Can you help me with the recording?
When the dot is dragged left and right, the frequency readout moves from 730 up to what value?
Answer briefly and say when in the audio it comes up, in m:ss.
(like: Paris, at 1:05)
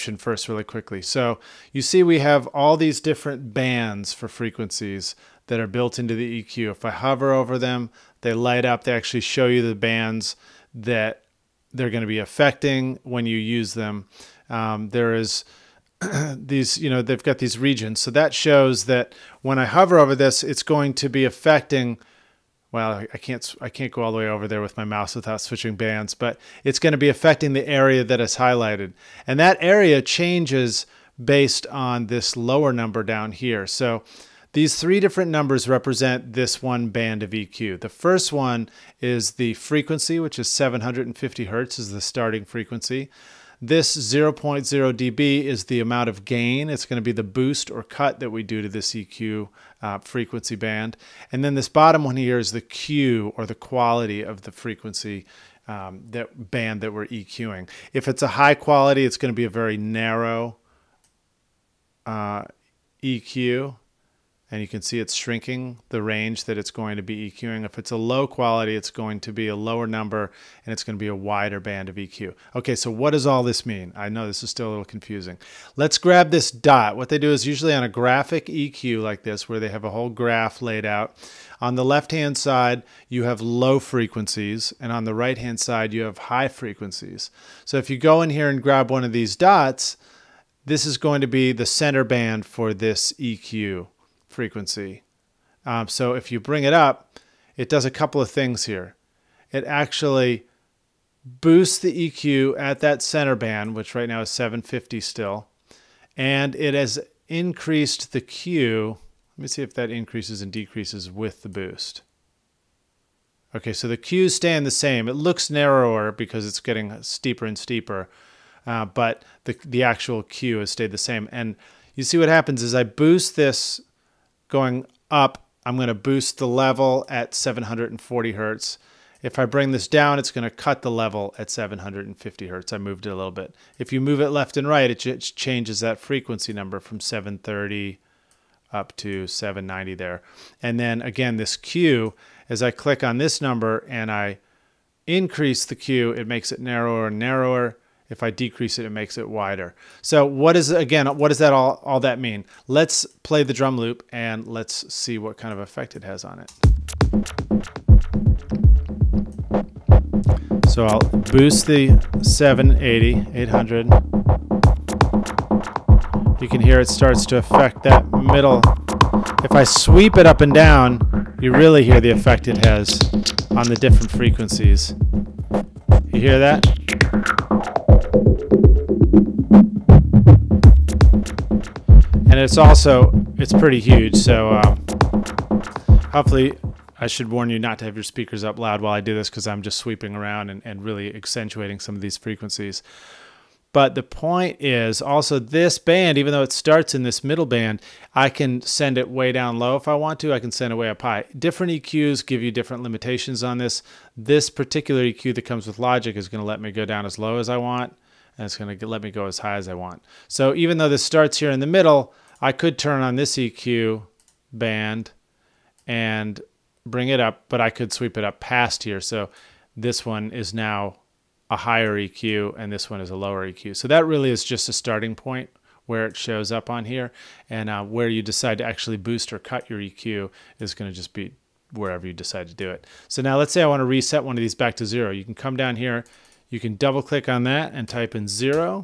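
790, at 2:19.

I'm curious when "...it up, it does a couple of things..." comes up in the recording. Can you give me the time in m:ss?
1:36.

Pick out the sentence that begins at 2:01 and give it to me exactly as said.
And you see what happens is I boost this going up, I'm going to boost the level at 740 hertz.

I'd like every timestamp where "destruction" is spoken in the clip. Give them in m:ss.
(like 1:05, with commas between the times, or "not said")
not said.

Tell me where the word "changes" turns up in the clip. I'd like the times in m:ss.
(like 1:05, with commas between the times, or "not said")
0:30, 2:15.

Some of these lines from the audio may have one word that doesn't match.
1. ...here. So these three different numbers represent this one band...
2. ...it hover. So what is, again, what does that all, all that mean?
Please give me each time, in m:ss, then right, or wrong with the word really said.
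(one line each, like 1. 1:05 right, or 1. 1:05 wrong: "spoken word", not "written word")
1. 0:33 right
2. 2:29 wrong: "wider", not "hover".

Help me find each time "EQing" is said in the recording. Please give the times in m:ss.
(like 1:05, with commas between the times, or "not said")
0:57, 1:07.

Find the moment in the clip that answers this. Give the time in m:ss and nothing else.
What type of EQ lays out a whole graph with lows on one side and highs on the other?
1:17.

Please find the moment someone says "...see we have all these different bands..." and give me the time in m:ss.
0:01.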